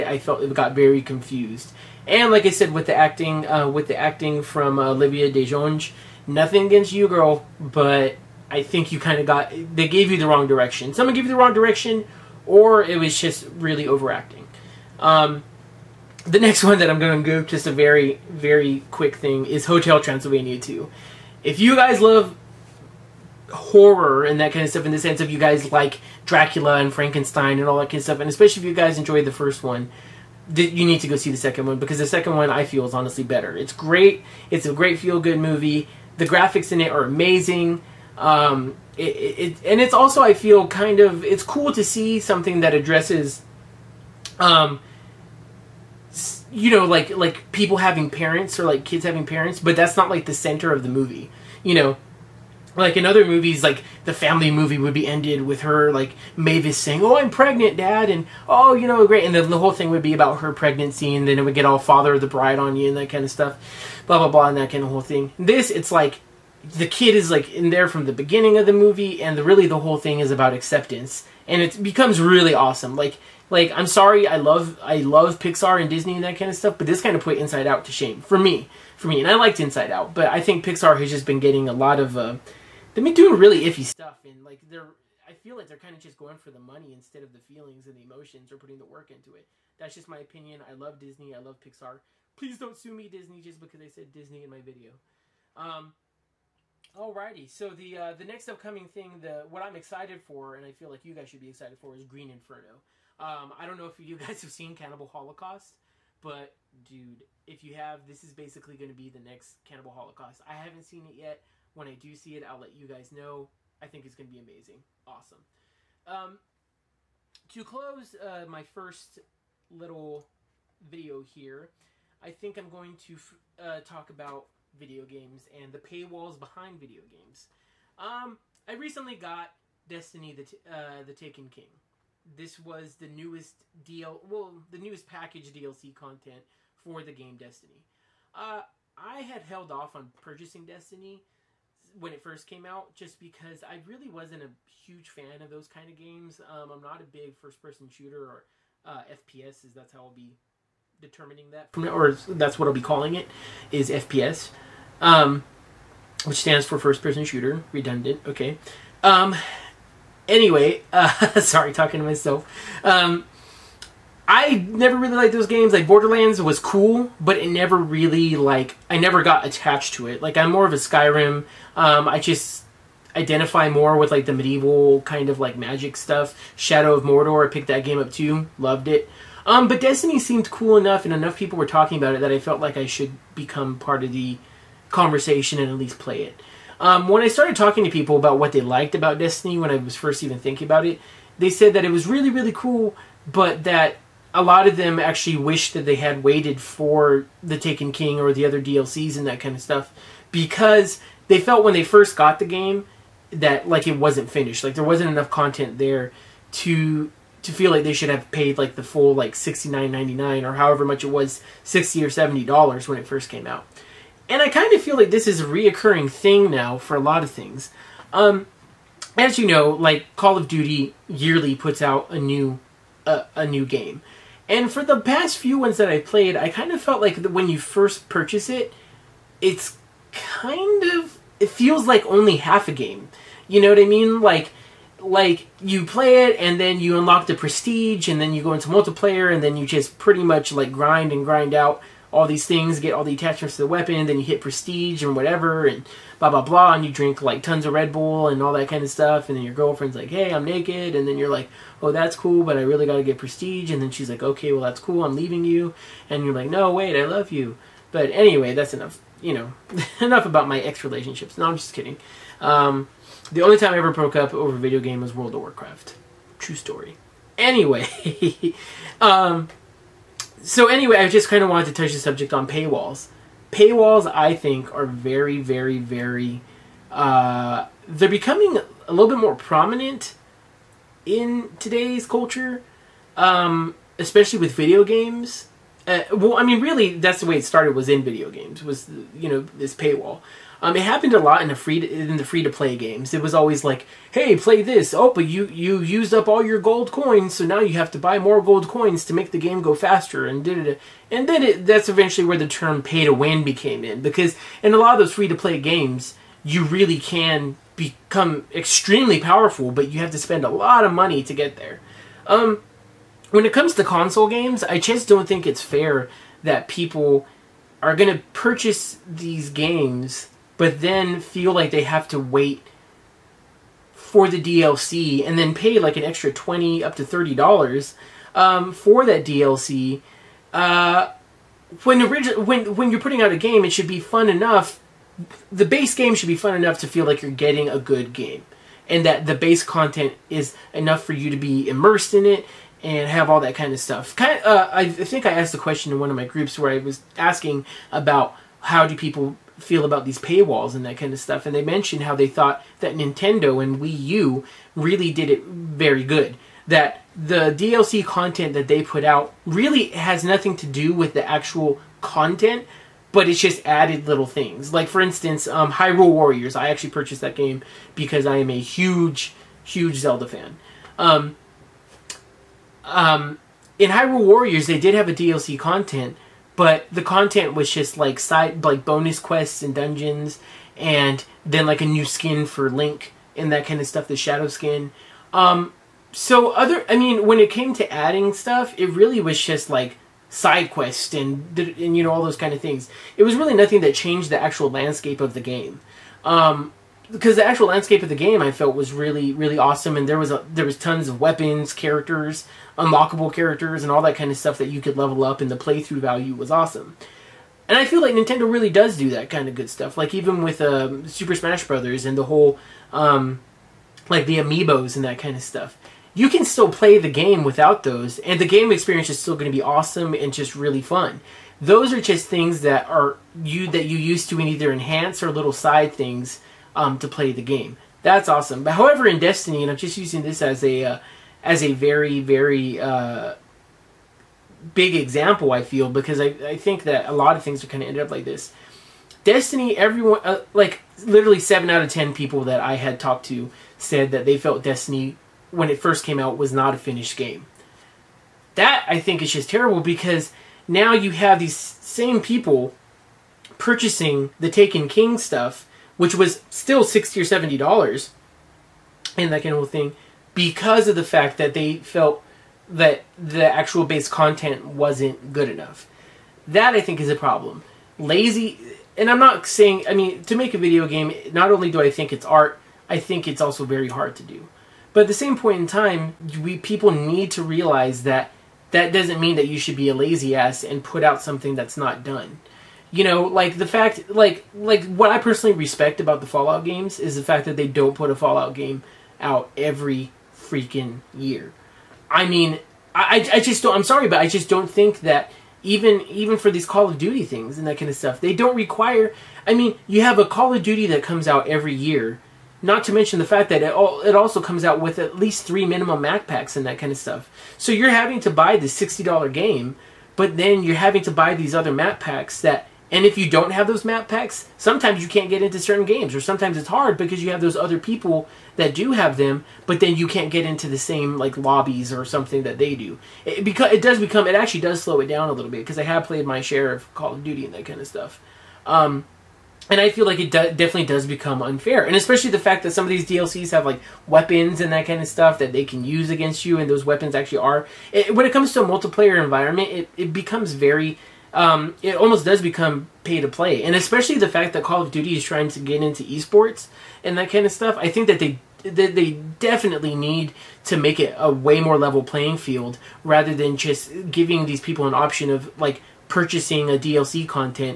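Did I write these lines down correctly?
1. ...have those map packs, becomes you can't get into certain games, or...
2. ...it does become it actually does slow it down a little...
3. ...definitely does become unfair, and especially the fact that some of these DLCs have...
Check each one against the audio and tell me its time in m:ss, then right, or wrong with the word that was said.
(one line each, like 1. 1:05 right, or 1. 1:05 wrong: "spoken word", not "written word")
1. 8:33 wrong: "sometimes", not "becomes"
2. 8:43 right
3. 8:50 right.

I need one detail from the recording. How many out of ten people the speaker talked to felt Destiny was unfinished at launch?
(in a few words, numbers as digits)
7.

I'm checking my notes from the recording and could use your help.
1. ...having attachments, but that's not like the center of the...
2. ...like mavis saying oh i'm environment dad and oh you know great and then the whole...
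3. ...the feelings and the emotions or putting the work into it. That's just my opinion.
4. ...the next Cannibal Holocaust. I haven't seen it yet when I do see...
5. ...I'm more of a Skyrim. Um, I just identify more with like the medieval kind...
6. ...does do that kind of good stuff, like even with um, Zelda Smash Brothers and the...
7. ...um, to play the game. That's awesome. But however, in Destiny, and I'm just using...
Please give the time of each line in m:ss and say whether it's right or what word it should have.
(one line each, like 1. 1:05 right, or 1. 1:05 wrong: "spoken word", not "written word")
1. 0:49 wrong: "parents", not "attachments"
2. 0:55 wrong: "pregnant", not "environment"
3. 1:27 right
4. 1:49 right
5. 2:50 right
6. 6:48 wrong: "Super", not "Zelda"
7. 7:06 right.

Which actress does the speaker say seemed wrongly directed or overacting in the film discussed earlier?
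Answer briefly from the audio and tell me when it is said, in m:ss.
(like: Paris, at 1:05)
Olivia DeJonge, at 0:04.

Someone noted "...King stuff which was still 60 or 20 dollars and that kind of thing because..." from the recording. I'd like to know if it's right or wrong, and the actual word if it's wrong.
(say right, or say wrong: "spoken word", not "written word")
wrong: "70", not "20".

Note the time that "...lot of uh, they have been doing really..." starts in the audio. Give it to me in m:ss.
1:21.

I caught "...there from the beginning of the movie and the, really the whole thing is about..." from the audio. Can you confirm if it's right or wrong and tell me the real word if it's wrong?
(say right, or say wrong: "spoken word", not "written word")
right.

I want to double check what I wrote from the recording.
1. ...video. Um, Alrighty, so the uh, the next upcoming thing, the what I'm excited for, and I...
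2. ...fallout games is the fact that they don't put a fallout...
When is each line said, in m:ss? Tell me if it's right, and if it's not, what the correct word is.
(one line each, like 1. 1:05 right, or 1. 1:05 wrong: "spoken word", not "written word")
1. 1:34 right
2. 8:06 right.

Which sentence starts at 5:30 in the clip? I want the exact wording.
Uh, when, origi- when, when you're putting out a game, it should be fun enough.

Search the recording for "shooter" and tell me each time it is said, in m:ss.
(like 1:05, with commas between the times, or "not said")
2:27, 2:37.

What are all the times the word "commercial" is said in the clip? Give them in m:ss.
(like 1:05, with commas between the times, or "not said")
not said.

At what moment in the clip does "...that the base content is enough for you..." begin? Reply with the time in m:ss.
5:39.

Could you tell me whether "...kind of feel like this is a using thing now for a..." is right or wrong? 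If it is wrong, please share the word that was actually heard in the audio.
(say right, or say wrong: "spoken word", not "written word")
wrong: "reoccurring", not "using".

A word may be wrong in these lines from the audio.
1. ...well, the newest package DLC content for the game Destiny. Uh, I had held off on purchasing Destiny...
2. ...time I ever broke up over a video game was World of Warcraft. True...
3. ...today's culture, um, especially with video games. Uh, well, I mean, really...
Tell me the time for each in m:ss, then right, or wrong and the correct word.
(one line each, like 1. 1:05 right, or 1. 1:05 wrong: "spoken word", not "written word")
1. 2:14 right
2. 4:23 right
3. 4:41 right.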